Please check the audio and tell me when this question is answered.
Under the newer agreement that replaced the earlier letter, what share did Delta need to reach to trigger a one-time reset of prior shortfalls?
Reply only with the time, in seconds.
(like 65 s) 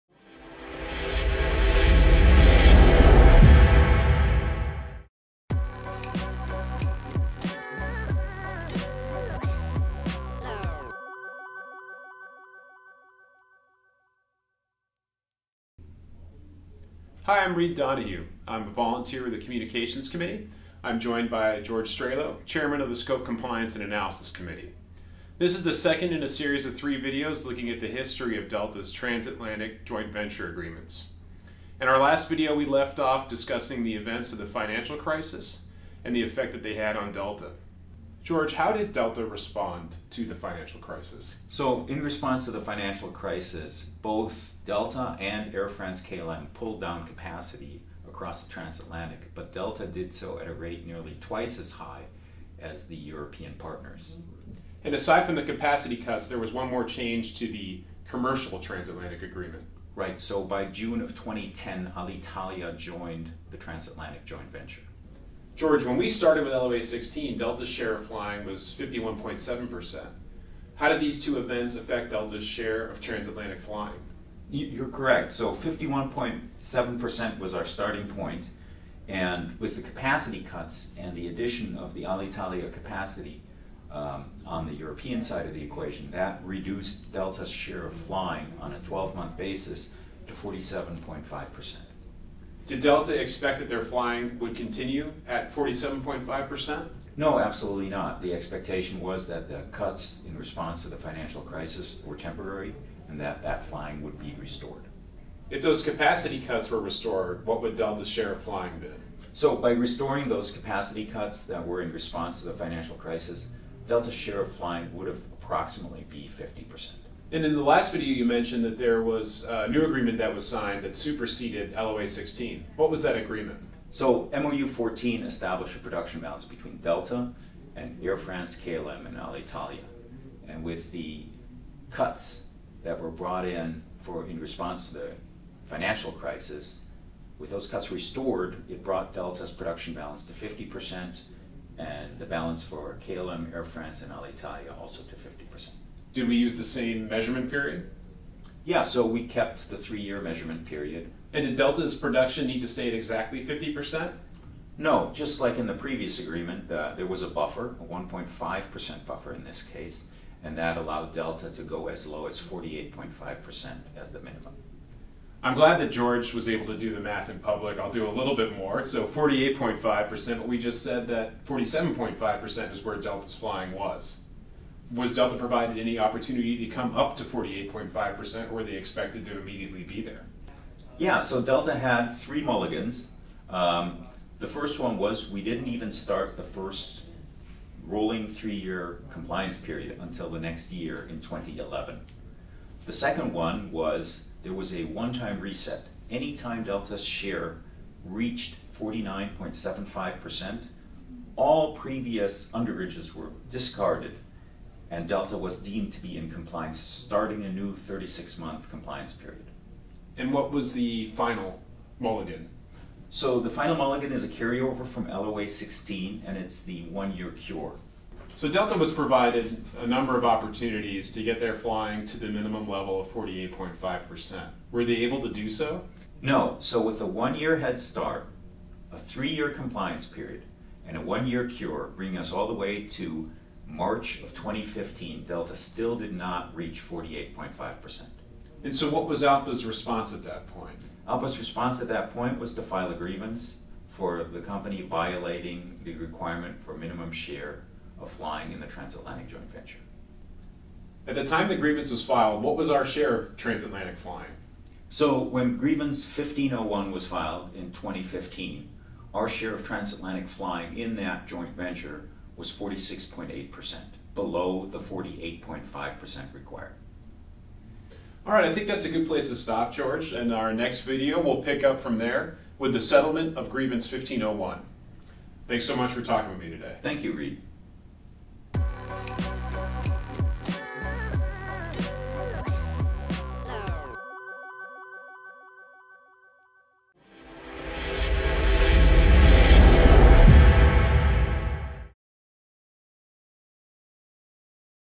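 198 s.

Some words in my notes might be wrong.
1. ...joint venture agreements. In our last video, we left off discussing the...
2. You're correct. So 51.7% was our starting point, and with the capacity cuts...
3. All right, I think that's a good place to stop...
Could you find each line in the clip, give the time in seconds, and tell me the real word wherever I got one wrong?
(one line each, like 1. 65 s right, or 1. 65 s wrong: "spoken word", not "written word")
1. 29 s right
2. 74 s right
3. 268 s right.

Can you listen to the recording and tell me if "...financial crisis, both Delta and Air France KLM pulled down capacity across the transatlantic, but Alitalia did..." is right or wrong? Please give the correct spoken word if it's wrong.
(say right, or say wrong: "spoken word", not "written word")
wrong: "Delta", not "Alitalia".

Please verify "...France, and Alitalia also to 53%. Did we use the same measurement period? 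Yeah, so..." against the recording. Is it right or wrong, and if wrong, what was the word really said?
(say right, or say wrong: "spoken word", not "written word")
wrong: "50", not "53".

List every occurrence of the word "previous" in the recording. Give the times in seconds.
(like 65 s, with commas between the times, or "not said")
155 s, 201 s.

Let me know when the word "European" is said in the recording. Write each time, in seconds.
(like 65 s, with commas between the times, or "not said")
52 s, 84 s.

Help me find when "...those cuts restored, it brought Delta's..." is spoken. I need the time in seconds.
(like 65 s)
137 s.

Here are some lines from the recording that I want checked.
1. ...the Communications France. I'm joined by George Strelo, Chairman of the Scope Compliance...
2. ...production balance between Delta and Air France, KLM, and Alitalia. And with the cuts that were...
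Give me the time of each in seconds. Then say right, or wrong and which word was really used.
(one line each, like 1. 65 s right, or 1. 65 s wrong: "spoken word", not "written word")
1. 19 s wrong: "Committee", not "France"
2. 125 s right.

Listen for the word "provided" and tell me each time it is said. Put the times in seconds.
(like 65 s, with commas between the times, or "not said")
175 s, 218 s.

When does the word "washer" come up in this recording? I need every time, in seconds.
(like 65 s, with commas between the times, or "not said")
not said.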